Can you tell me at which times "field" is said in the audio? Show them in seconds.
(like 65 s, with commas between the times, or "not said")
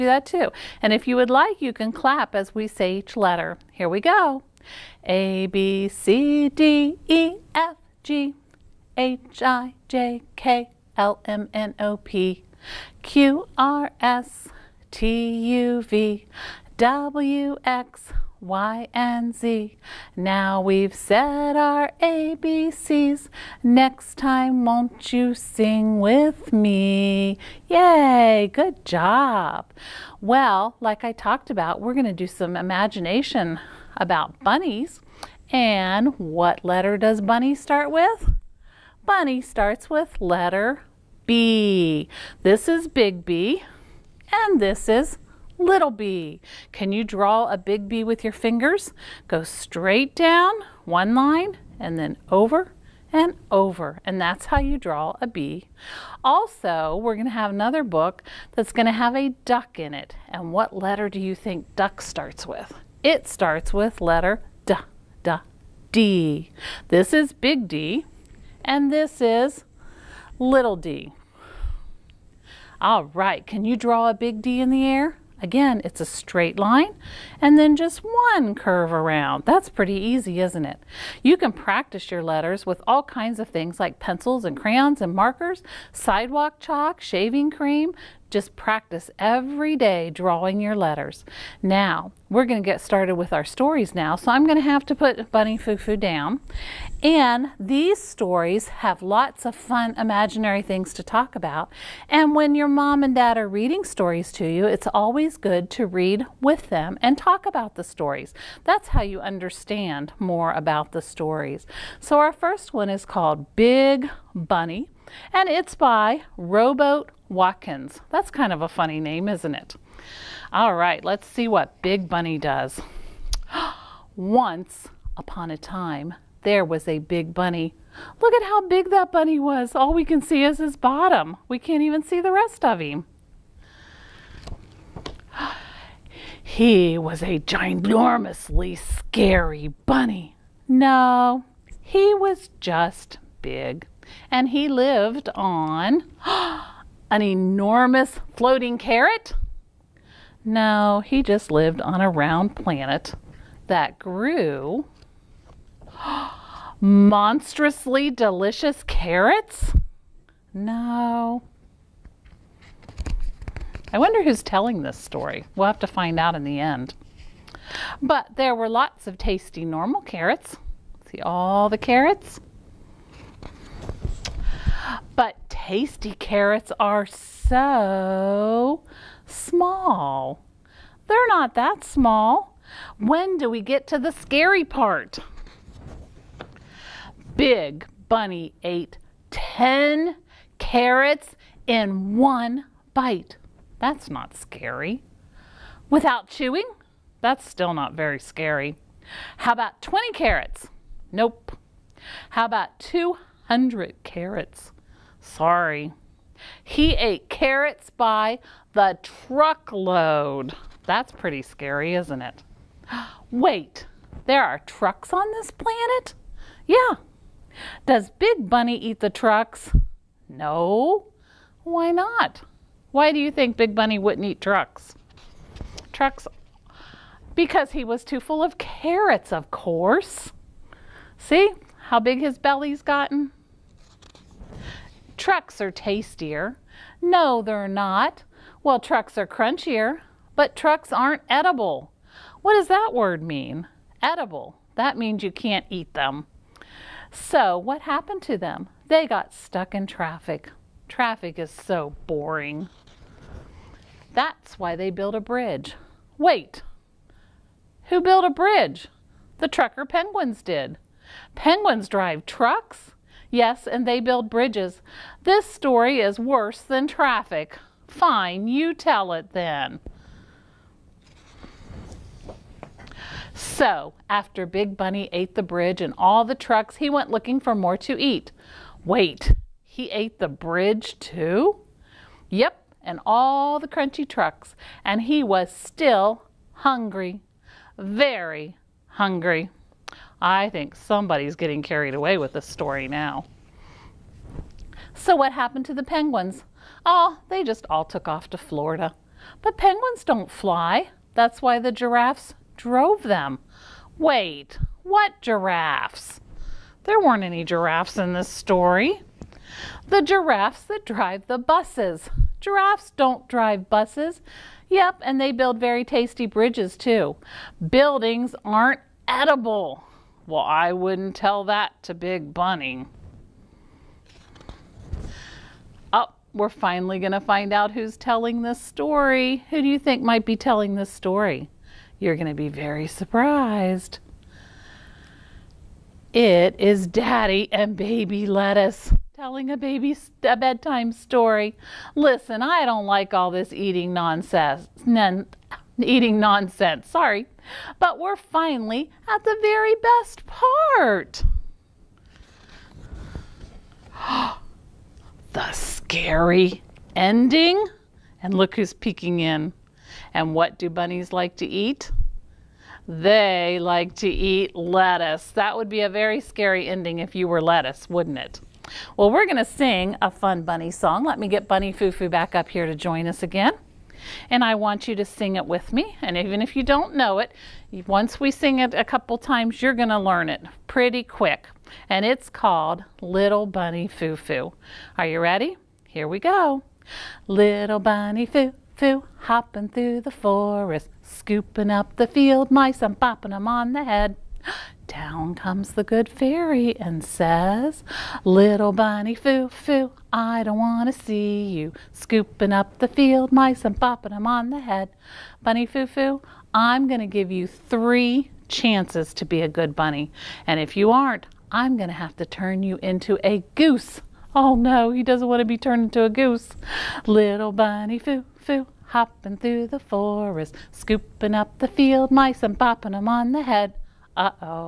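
392 s, 402 s, 421 s.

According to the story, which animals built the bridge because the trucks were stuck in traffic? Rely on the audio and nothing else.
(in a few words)
The trucker penguins.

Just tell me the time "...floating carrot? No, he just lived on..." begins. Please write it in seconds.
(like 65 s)
148 s.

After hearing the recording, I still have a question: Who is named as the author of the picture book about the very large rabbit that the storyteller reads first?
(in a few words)
Rowboat Watkins.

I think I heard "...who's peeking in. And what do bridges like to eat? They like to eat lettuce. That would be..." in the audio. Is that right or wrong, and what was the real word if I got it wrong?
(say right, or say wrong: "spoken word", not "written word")
wrong: "bunnies", not "bridges".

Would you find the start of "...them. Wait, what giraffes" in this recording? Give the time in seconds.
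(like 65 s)
303 s.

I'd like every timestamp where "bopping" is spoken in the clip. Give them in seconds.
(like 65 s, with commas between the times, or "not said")
392 s, 403 s, 422 s.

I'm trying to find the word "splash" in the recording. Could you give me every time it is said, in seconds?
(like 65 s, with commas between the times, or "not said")
not said.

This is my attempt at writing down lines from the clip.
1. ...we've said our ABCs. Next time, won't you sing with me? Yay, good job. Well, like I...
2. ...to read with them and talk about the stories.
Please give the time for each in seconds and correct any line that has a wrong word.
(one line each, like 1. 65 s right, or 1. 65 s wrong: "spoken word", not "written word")
1. 20 s right
2. 105 s right.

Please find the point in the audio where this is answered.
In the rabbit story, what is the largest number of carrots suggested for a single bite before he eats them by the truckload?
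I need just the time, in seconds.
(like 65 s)
202 s.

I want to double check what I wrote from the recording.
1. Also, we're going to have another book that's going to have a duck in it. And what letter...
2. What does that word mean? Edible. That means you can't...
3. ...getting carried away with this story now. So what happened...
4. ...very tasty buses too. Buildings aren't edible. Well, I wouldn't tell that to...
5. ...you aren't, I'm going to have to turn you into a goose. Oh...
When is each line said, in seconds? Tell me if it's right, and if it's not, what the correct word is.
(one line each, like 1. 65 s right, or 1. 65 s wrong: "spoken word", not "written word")
1. 56 s right
2. 242 s right
3. 291 s right
4. 315 s wrong: "bridges", not "buses"
5. 410 s right.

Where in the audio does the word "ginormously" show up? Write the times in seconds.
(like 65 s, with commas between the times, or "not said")
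137 s.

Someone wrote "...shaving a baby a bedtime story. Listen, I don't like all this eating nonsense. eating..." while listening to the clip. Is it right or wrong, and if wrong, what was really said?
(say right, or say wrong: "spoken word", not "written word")
wrong: "telling", not "shaving".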